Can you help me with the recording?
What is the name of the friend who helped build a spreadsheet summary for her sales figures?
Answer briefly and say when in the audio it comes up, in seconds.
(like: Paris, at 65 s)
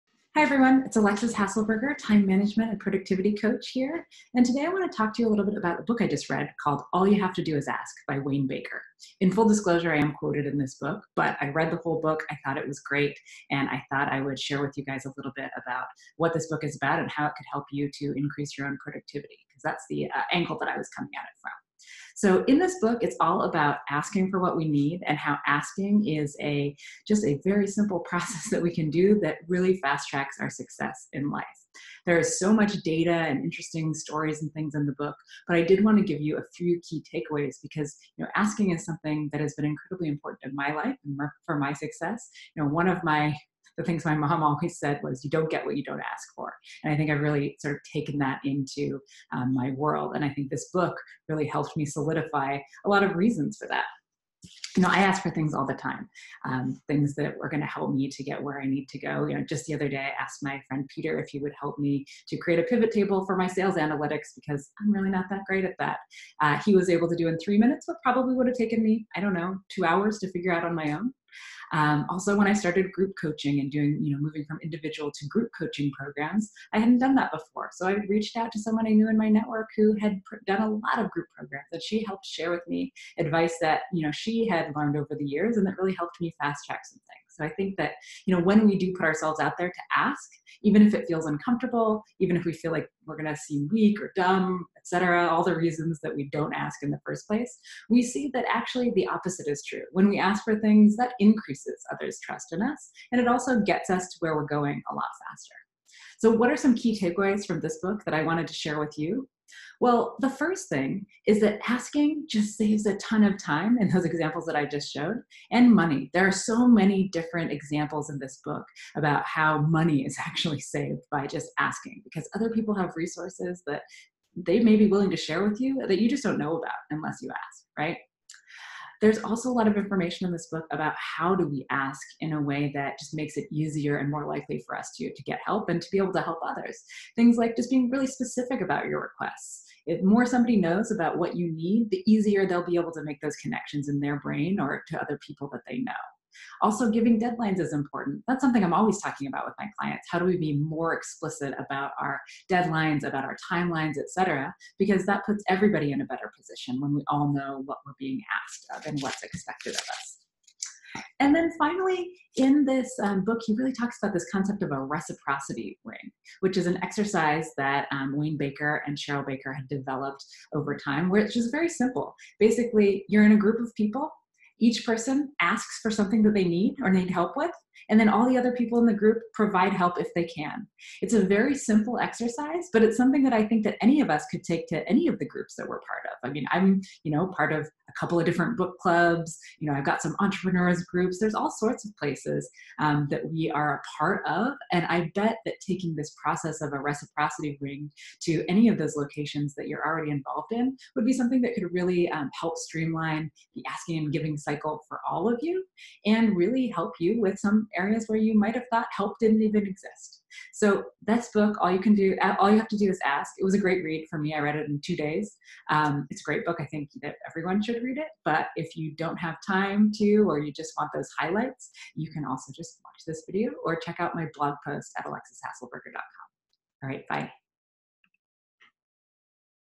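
Peter, at 60 s.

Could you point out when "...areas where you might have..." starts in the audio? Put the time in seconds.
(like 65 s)
207 s.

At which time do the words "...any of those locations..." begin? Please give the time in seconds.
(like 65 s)
198 s.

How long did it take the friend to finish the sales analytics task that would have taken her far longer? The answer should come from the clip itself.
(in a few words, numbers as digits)
3 minutes.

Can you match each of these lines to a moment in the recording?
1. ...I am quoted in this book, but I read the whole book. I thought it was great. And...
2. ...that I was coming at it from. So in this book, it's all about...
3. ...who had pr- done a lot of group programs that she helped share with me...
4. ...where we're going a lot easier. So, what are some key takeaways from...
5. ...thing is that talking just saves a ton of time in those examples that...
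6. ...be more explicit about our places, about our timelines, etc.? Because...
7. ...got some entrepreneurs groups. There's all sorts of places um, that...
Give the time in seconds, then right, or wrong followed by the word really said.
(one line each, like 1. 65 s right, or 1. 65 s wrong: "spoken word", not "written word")
1. 9 s right
2. 20 s right
3. 79 s right
4. 104 s wrong: "faster", not "easier"
5. 110 s wrong: "asking", not "talking"
6. 150 s wrong: "deadlines", not "places"
7. 189 s right.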